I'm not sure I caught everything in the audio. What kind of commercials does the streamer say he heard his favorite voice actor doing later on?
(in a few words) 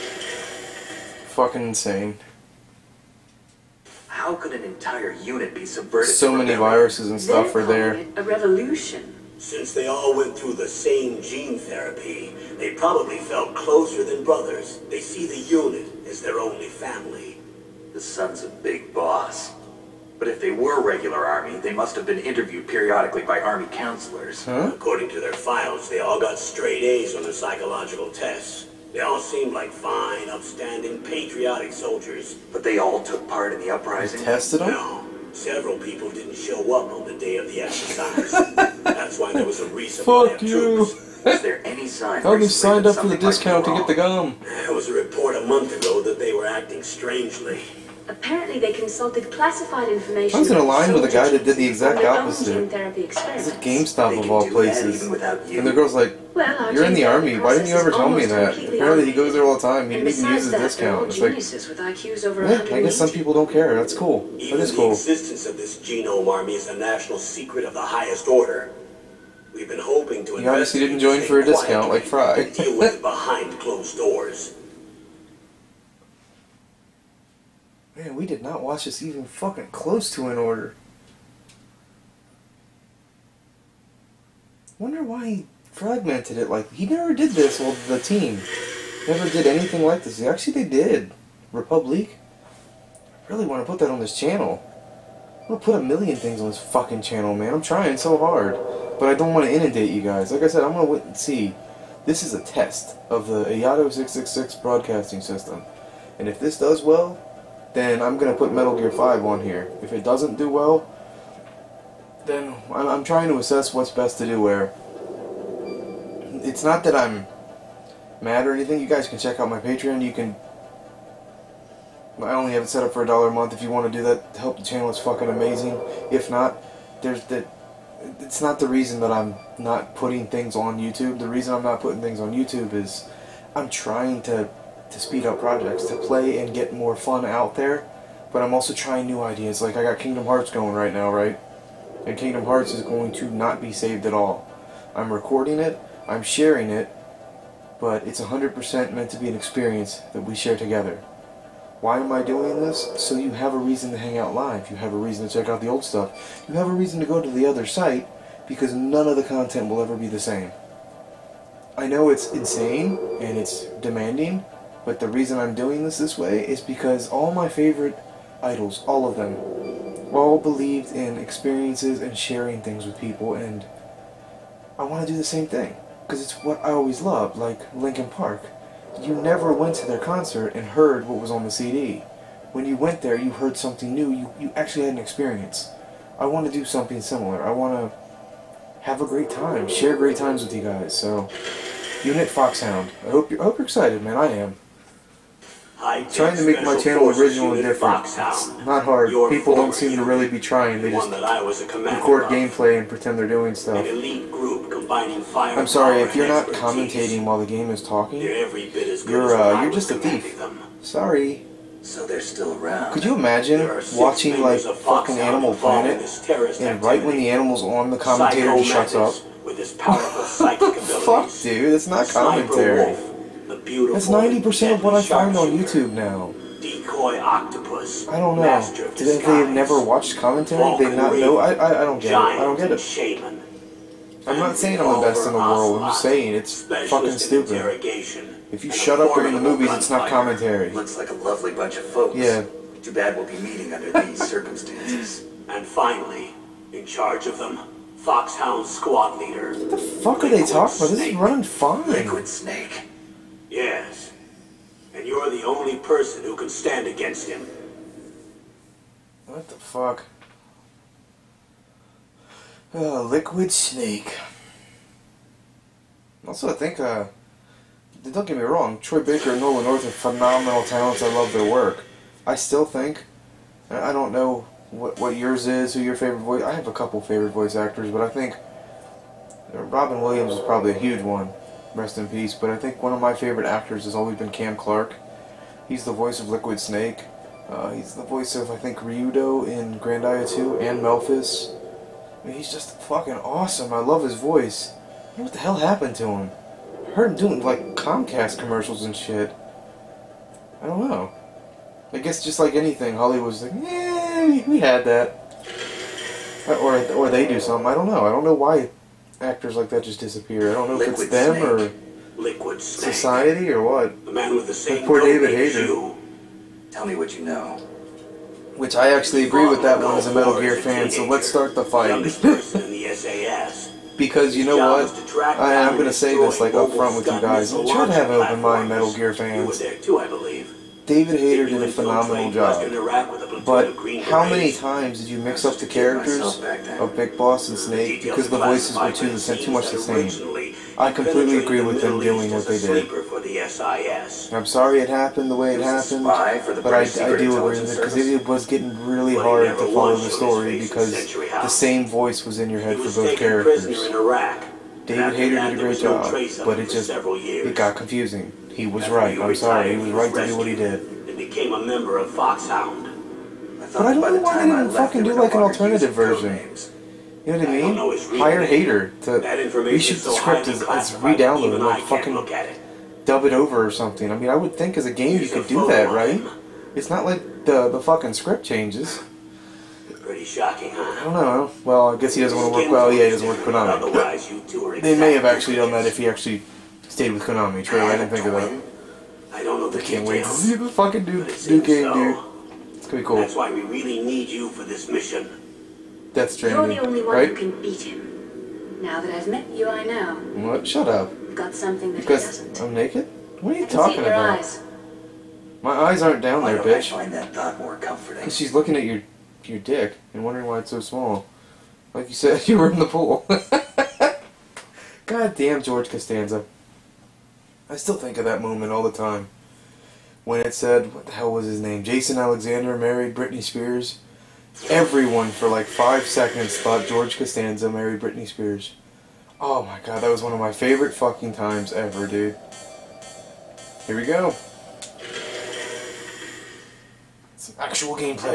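Comcast commercials.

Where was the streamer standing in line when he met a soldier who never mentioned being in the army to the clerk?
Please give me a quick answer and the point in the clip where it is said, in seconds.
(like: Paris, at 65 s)
GameStop, at 53 s.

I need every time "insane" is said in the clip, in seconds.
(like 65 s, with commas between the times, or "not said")
1 s, 162 s.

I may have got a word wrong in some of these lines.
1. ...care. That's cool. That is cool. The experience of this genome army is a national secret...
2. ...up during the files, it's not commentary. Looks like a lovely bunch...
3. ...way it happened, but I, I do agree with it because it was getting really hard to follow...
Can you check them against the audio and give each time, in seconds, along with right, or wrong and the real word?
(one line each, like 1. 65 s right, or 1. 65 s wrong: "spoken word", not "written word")
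1. 63 s wrong: "existence", not "experience"
2. 238 s wrong: "movies", not "files"
3. 345 s right.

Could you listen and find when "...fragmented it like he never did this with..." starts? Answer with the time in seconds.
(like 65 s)
85 s.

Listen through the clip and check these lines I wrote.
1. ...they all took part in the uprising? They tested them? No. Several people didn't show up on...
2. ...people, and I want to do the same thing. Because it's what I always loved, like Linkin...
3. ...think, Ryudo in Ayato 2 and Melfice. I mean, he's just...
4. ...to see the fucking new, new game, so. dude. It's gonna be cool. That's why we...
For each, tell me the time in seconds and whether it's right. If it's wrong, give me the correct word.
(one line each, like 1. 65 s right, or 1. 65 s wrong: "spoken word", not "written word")
1. 32 s right
2. 172 s right
3. 288 s wrong: "Grandia", not "Ayato"
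4. 390 s right.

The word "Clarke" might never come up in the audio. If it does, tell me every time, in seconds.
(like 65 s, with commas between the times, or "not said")
284 s.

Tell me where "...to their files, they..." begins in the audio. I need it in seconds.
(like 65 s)
25 s.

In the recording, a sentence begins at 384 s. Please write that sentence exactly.
they may have actually done that if he actually stayed with Konami.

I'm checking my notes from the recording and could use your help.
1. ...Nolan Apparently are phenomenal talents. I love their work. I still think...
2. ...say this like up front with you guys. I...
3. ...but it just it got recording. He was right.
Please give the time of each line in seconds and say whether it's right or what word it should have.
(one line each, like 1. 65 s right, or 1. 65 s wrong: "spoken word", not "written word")
1. 269 s wrong: "North", not "Apparently"
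2. 325 s right
3. 356 s wrong: "confusing", not "recording".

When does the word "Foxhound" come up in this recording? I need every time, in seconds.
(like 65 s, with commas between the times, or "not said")
192 s, 247 s, 362 s.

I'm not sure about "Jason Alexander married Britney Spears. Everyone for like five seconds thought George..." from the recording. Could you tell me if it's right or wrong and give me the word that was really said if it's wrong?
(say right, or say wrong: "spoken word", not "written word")
right.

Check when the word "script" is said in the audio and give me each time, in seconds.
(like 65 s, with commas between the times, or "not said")
370 s, 378 s.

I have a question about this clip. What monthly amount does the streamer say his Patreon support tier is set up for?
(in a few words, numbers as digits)
a dollar.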